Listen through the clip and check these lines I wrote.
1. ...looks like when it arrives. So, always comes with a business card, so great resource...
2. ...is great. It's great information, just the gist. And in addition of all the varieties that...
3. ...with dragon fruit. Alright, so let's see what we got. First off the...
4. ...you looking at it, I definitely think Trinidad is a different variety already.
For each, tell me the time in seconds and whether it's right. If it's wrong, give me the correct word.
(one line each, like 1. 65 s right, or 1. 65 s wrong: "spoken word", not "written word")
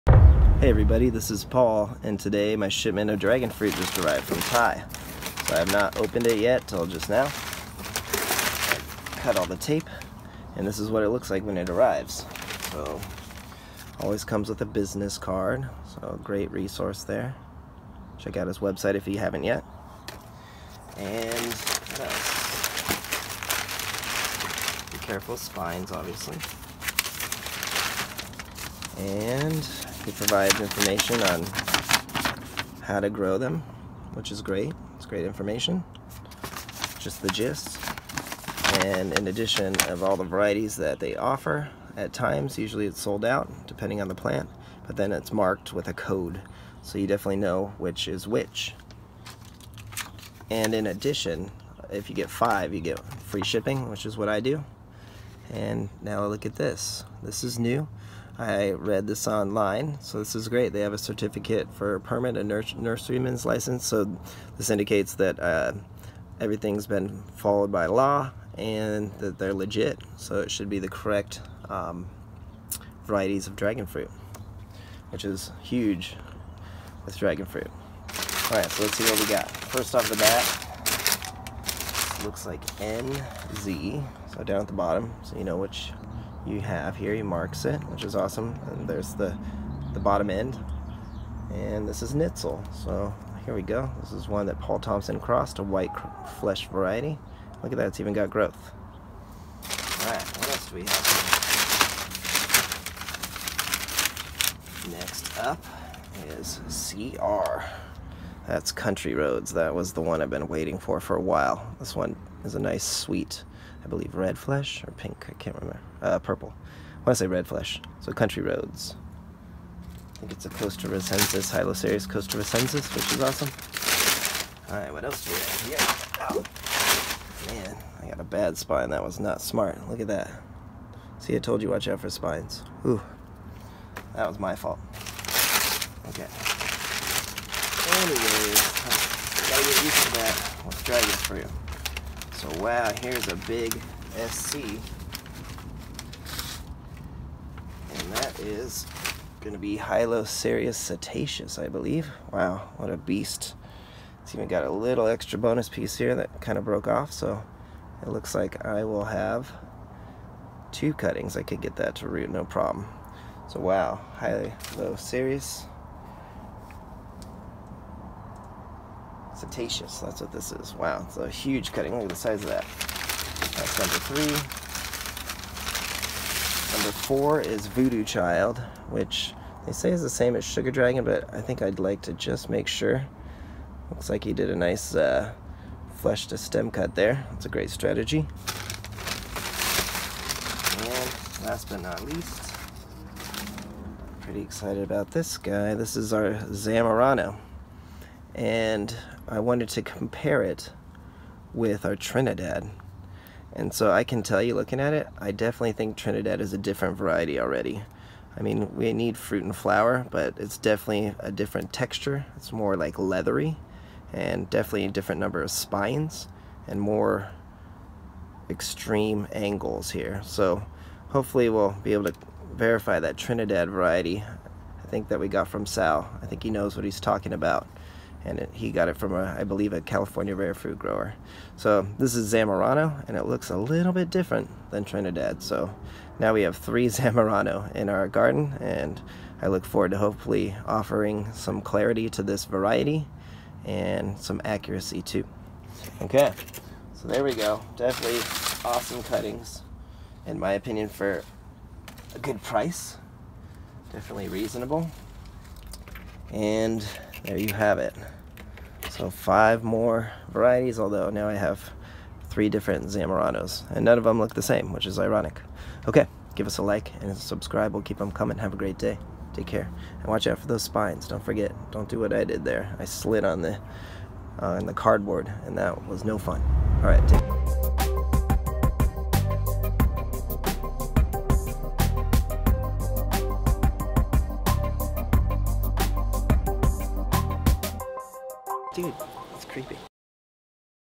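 1. 11 s right
2. 34 s right
3. 77 s right
4. 204 s right.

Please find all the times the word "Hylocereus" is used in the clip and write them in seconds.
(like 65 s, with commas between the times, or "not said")
121 s, 149 s, 164 s.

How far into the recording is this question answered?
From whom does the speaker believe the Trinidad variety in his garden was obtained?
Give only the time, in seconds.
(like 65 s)
225 s.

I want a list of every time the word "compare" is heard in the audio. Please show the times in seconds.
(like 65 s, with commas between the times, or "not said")
199 s.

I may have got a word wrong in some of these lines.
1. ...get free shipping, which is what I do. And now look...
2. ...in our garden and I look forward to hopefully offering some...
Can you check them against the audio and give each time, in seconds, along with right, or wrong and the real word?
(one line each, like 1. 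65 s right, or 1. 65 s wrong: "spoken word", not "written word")
1. 52 s right
2. 237 s right.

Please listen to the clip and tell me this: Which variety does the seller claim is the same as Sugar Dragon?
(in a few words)
Voodoo Child.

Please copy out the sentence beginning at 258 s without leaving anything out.
So five more varieties, although now I have three different Zamoranos, and none of them look the same, which is ironic.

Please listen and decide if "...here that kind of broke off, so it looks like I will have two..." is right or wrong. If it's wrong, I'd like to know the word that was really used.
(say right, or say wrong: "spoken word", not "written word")
right.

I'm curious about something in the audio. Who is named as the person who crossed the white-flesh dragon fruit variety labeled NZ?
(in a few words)
Paul Thomson.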